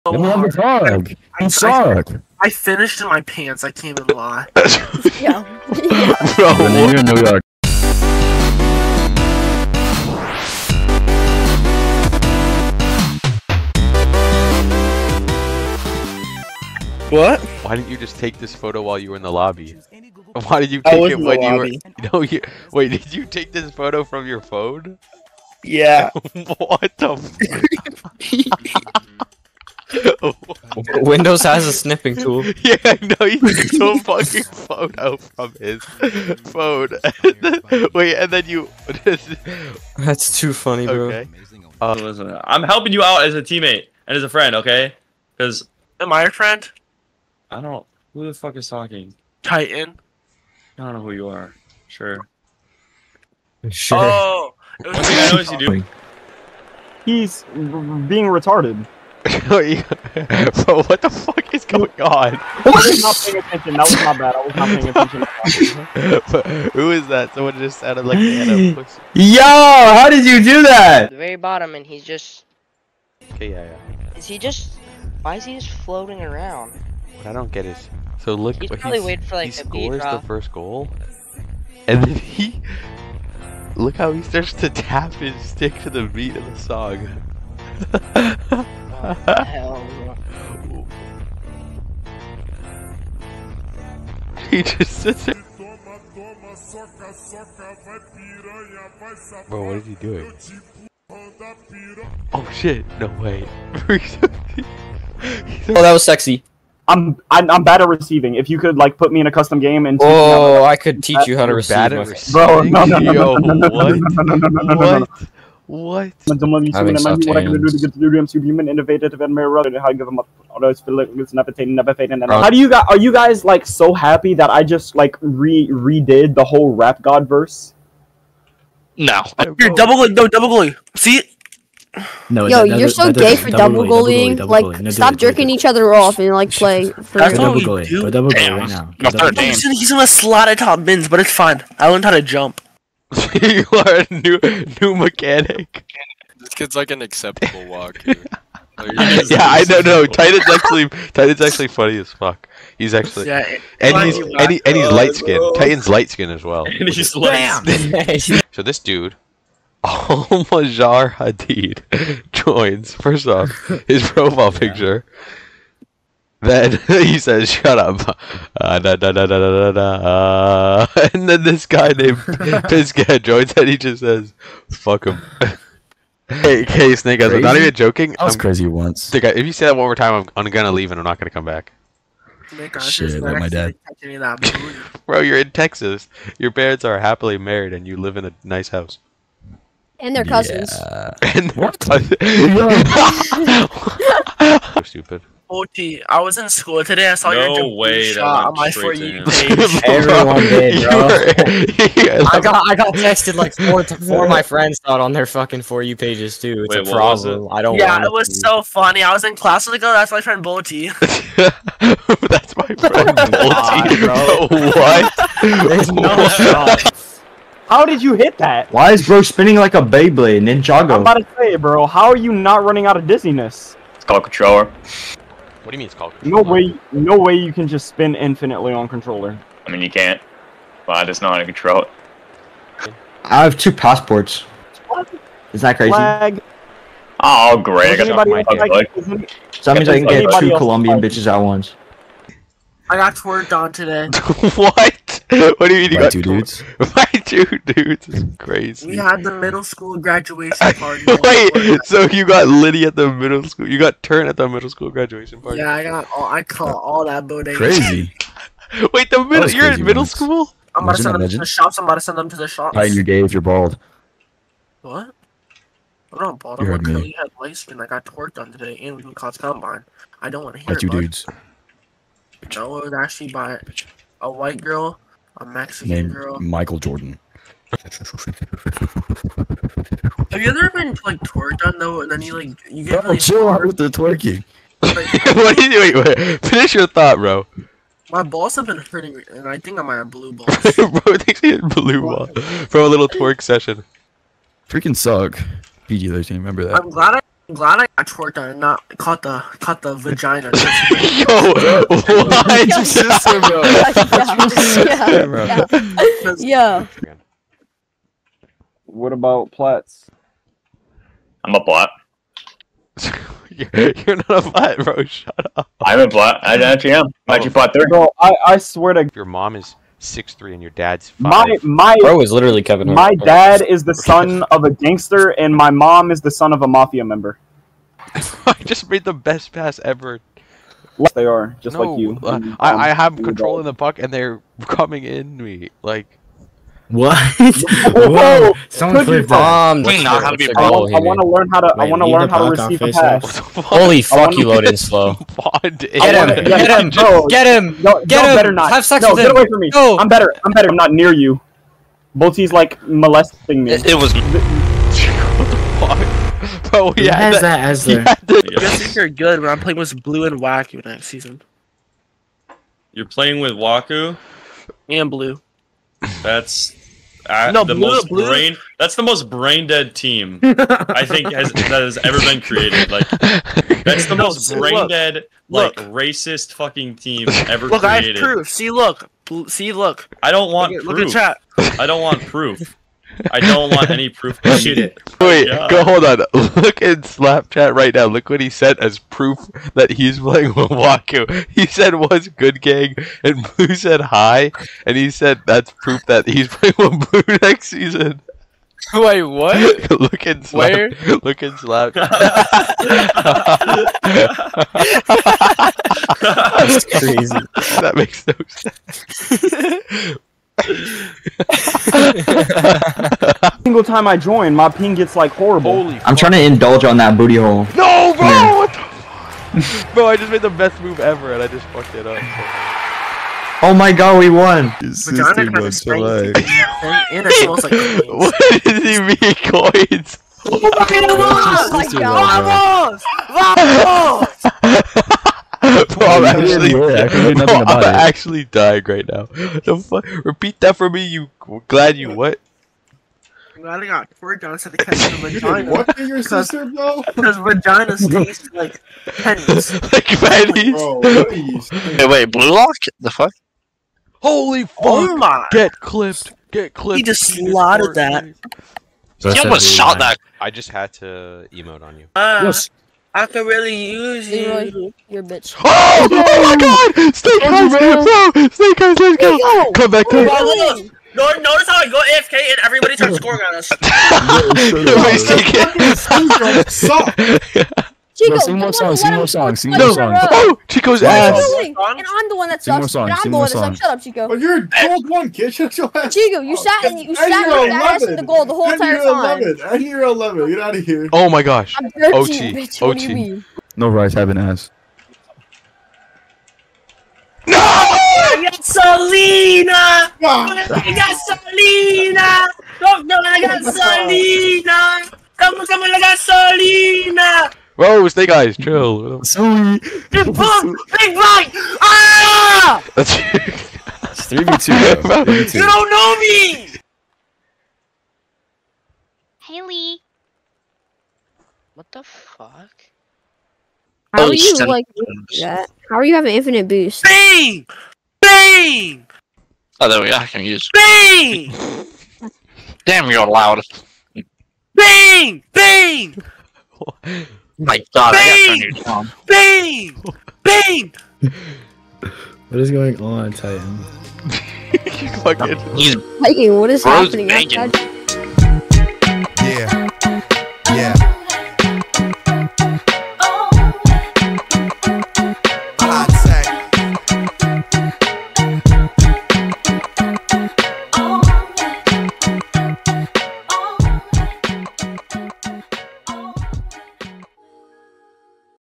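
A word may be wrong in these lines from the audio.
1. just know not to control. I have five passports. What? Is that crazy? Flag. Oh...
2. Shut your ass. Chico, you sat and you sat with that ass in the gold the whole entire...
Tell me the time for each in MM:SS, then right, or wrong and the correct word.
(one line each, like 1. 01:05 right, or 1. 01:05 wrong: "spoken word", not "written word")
1. 03:51 wrong: "two", not "five"
2. 08:05 right.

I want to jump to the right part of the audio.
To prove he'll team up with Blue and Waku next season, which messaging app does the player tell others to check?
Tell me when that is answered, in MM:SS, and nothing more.
06:27.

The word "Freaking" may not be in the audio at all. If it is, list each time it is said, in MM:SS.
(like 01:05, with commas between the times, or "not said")
04:54.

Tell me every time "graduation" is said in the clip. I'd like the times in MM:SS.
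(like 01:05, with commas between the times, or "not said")
04:09, 04:14.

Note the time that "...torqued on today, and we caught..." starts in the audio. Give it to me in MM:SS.
04:28.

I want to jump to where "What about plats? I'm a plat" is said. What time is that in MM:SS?
05:08.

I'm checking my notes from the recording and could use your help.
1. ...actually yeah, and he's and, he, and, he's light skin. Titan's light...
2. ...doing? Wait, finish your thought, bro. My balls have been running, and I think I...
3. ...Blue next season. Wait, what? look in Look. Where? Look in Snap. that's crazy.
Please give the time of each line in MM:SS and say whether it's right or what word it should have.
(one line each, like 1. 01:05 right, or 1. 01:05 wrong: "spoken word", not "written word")
1. 02:32 right
2. 04:45 wrong: "hurting", not "running"
3. 06:37 wrong: "Snap", not "Look".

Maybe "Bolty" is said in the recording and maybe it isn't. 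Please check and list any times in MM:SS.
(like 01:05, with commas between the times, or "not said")
03:30, 03:34, 05:52.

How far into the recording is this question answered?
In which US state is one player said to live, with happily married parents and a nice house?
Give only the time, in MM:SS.
03:05.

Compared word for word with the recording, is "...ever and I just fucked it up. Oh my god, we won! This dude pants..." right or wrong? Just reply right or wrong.
wrong.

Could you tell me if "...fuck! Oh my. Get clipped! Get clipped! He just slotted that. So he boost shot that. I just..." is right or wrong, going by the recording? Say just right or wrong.
wrong.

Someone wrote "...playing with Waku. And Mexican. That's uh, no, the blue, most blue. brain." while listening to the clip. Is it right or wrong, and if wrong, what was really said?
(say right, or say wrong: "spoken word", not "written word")
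wrong: "Blue", not "Mexican".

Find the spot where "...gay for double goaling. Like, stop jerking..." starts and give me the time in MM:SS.
02:13.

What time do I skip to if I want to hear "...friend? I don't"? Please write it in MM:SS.
00:46.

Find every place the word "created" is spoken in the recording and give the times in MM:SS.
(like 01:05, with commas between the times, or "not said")
06:12, 06:17.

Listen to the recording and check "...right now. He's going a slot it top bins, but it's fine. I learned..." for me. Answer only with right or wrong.
right.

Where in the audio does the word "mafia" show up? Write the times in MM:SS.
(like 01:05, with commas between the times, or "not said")
05:26.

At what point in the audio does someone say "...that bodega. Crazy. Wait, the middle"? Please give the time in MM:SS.
04:17.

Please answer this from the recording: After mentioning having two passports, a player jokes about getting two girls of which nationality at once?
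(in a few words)
Colombian.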